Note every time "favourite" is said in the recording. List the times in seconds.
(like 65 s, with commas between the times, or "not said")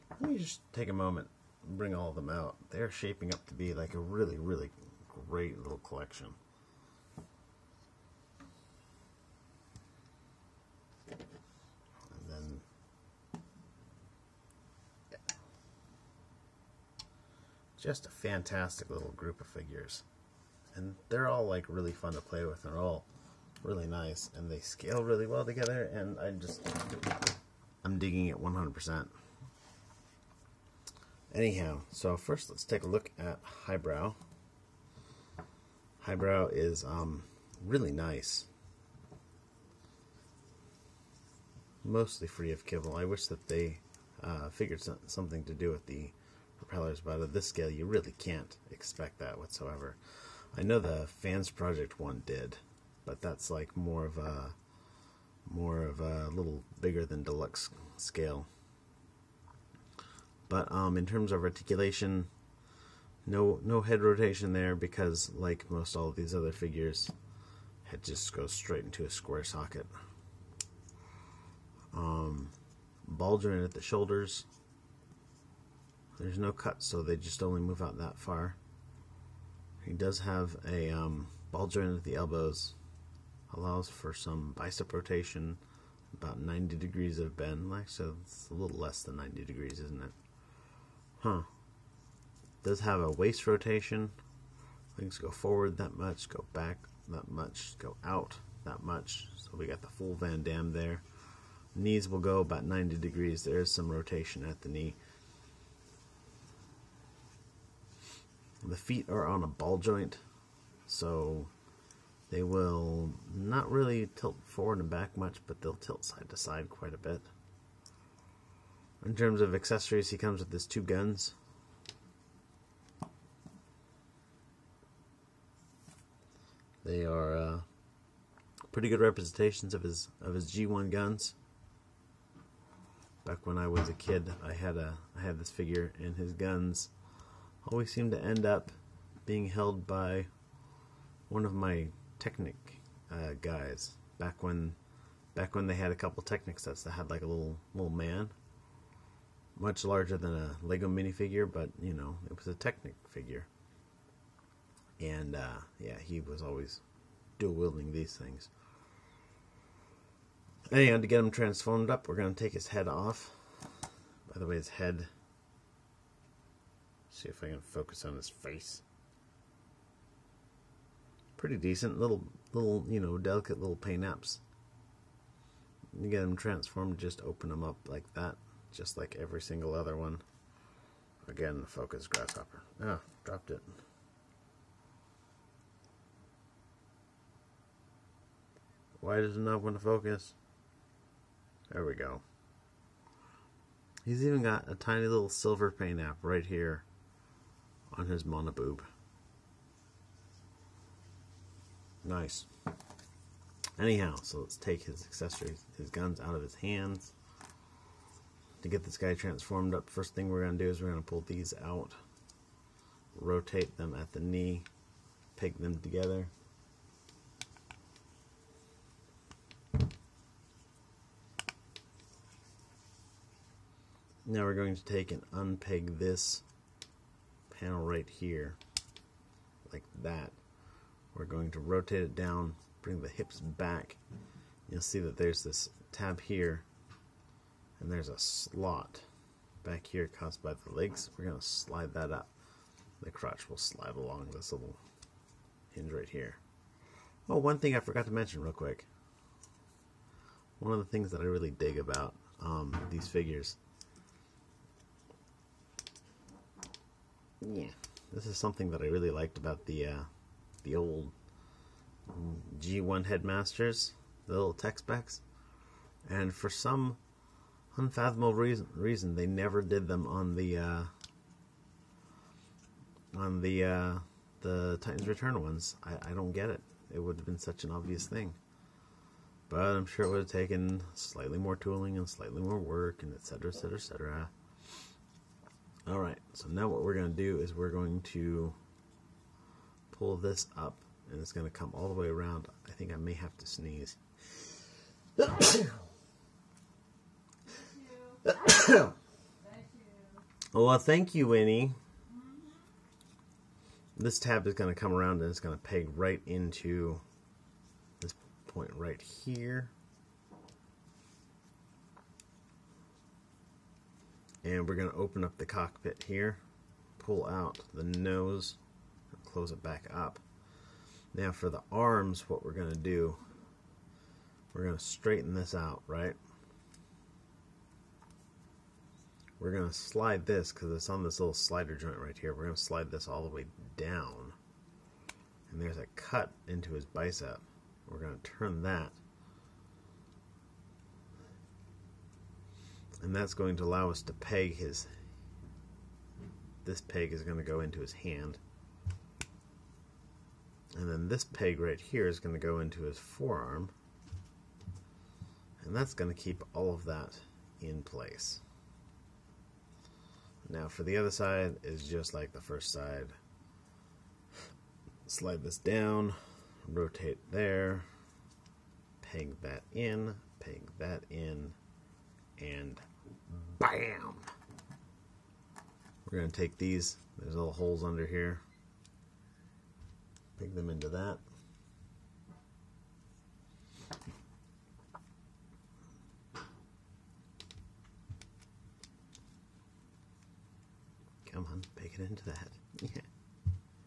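not said.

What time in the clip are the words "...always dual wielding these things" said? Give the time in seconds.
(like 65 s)
156 s.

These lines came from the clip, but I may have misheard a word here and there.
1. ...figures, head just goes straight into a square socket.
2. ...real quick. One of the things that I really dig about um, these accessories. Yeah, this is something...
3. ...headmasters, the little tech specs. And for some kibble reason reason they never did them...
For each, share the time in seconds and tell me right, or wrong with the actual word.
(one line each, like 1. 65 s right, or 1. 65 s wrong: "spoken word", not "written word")
1. 66 s right
2. 248 s wrong: "figures", not "accessories"
3. 263 s wrong: "unfathomable", not "kibble".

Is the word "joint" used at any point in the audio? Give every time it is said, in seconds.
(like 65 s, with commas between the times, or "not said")
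73 s, 81 s, 109 s, 331 s.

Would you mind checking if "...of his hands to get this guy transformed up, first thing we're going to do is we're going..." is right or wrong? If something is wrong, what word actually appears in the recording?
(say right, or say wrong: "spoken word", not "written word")
right.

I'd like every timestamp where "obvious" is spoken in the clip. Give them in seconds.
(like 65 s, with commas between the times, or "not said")
277 s.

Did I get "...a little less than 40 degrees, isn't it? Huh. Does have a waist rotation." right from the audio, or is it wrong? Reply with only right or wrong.
wrong.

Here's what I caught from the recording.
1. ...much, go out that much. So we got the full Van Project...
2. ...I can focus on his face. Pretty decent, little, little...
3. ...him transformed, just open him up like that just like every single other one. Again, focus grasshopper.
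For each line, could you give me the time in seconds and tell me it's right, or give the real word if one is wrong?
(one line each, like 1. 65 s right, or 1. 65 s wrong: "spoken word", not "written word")
1. 97 s wrong: "Damme", not "Project"
2. 167 s right
3. 176 s right.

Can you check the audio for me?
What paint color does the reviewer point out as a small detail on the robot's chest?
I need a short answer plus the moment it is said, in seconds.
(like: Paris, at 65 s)
silver, at 195 s.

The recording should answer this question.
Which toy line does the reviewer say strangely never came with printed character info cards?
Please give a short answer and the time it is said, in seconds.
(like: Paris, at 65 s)
Titans Return, at 274 s.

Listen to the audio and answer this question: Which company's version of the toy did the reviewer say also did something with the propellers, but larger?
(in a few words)
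Fans Project.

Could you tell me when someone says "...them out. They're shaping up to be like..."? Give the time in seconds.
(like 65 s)
2 s.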